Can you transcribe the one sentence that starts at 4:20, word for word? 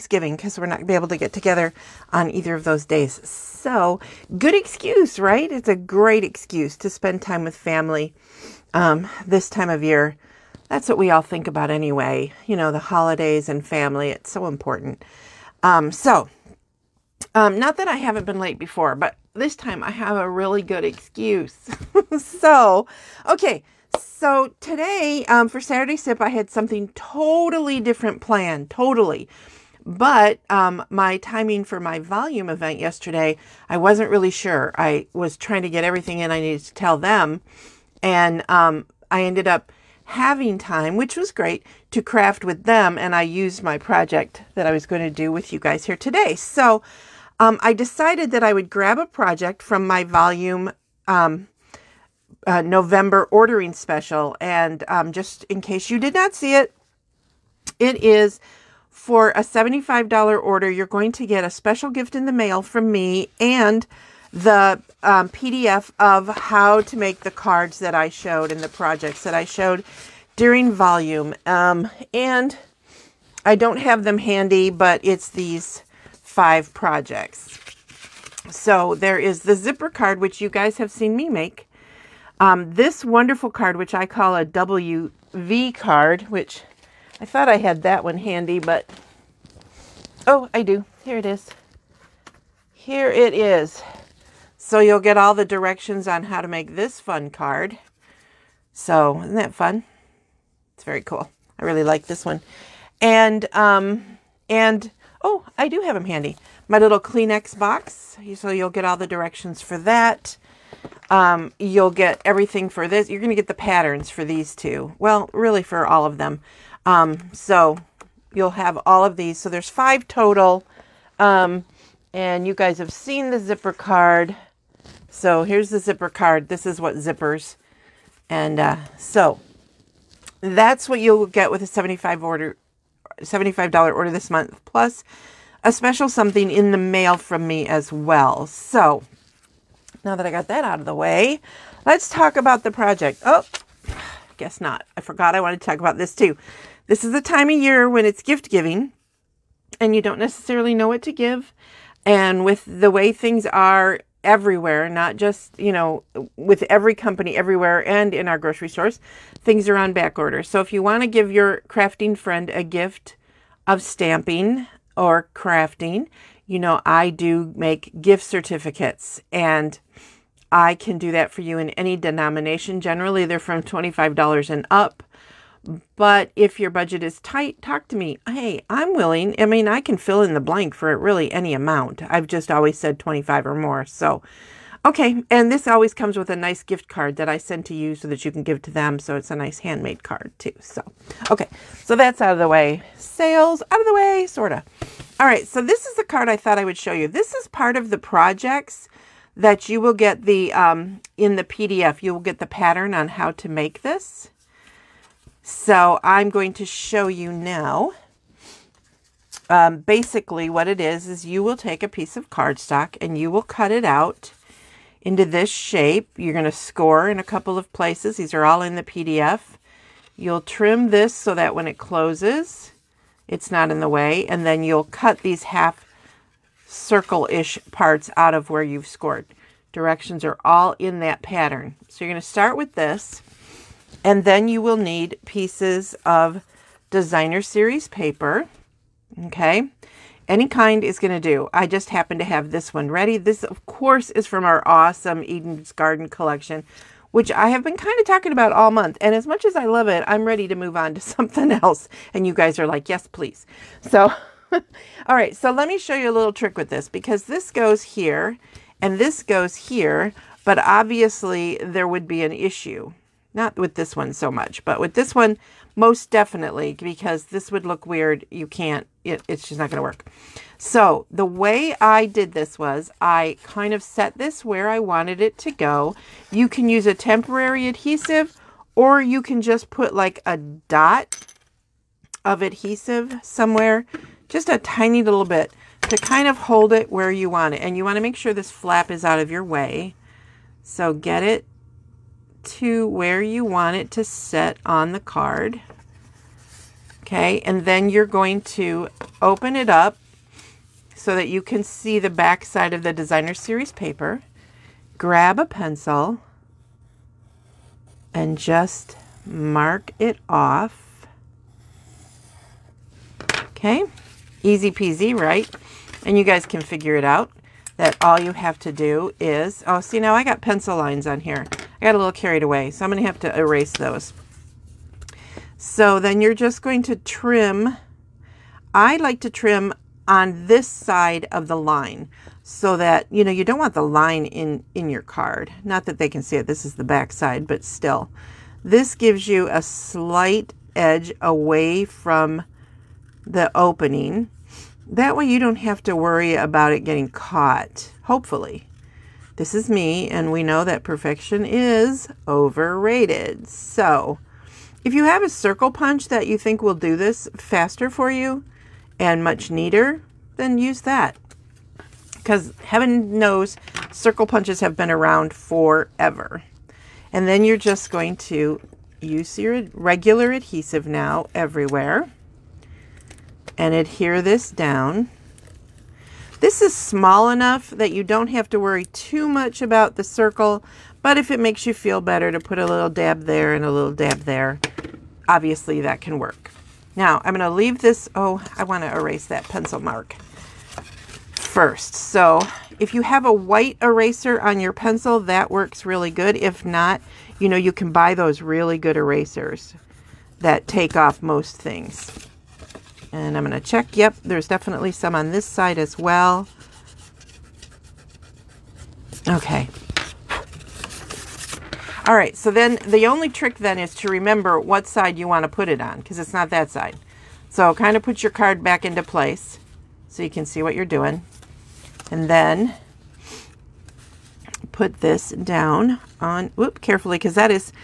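But obviously there would be an issue.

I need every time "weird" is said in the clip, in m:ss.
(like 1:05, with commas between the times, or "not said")
4:27.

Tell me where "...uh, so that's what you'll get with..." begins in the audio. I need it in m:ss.
2:08.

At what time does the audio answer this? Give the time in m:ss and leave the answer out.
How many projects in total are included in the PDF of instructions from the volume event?
1:59.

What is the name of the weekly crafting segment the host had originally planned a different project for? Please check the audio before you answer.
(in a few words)
Saturday Sip.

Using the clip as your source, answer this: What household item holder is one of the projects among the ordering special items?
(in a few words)
Kleenex box.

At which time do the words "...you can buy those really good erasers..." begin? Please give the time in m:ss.
6:37.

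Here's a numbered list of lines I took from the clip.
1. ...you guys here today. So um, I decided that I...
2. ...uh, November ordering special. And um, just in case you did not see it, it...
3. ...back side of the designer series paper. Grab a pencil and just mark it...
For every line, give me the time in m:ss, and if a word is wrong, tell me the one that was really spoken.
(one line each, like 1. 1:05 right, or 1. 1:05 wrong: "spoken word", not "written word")
1. 0:45 right
2. 0:52 right
3. 5:02 right.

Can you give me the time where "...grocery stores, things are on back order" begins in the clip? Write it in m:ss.
2:38.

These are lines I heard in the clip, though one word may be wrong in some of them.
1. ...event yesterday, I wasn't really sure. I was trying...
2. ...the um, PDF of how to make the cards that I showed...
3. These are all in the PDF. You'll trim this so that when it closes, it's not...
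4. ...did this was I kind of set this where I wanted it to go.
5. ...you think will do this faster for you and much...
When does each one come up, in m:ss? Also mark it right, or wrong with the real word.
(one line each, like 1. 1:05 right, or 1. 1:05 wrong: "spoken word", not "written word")
1. 0:32 right
2. 1:04 right
3. 3:38 right
4. 4:32 right
5. 5:56 right.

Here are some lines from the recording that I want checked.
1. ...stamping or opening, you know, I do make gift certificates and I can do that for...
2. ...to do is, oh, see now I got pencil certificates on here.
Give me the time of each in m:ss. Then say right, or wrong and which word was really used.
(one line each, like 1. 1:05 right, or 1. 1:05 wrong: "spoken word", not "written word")
1. 2:43 wrong: "crafting", not "opening"
2. 5:18 wrong: "lines", not "certificates".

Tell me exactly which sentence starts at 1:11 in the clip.
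Um, and I don't have them handy, but it's these five projects.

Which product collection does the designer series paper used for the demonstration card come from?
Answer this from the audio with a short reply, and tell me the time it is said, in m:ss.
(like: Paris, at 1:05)
Eden's Garden, at 4:05.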